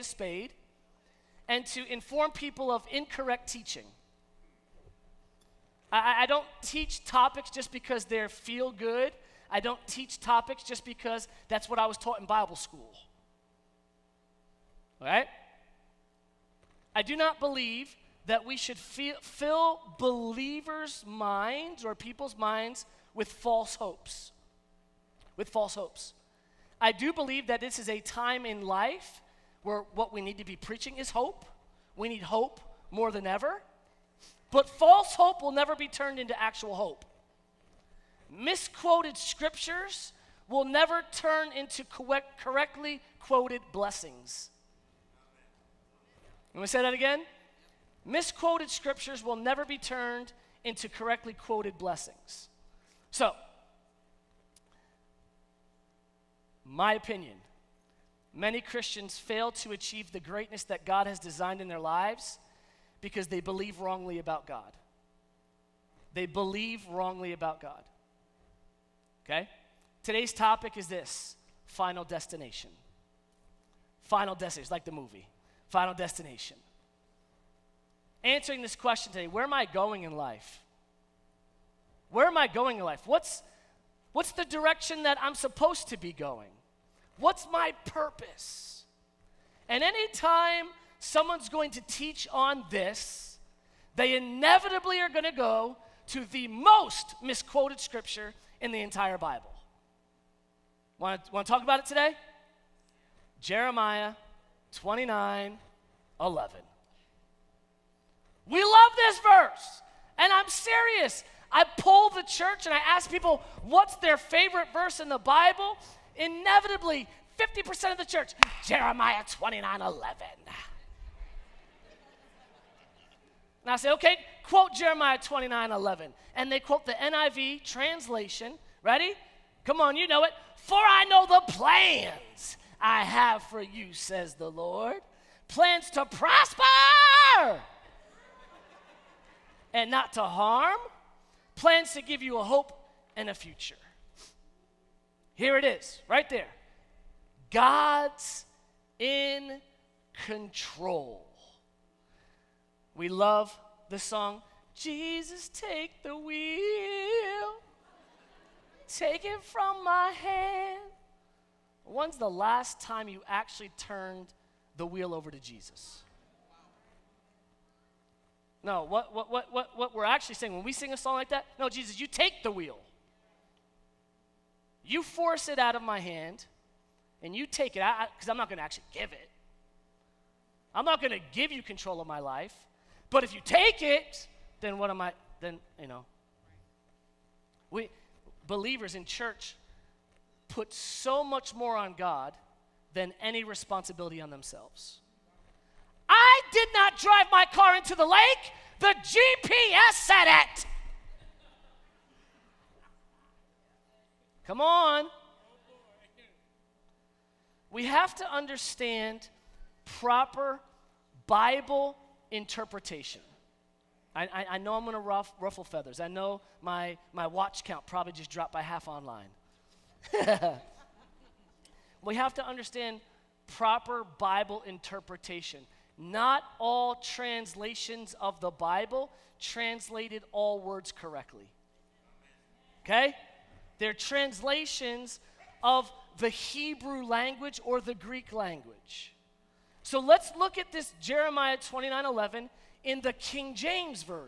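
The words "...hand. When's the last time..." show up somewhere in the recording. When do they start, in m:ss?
2:40.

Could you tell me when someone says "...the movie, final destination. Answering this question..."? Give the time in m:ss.
1:14.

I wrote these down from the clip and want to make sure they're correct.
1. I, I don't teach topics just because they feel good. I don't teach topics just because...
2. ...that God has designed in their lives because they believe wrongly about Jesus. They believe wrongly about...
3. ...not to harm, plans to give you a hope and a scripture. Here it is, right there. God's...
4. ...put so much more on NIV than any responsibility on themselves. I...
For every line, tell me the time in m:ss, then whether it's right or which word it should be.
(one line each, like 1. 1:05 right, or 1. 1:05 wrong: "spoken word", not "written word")
1. 0:05 right
2. 1:00 wrong: "God", not "Jesus"
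3. 2:19 wrong: "future", not "scripture"
4. 3:10 wrong: "God", not "NIV".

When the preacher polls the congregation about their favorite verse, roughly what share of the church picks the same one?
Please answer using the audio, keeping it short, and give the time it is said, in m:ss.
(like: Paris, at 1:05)
50%, at 1:57.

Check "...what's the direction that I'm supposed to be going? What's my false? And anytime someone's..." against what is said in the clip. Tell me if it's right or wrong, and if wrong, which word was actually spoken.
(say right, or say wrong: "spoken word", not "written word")
wrong: "purpose", not "false".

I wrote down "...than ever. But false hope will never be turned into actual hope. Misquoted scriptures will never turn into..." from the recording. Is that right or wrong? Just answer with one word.
right.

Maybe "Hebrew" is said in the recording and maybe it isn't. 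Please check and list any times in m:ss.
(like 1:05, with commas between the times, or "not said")
3:56.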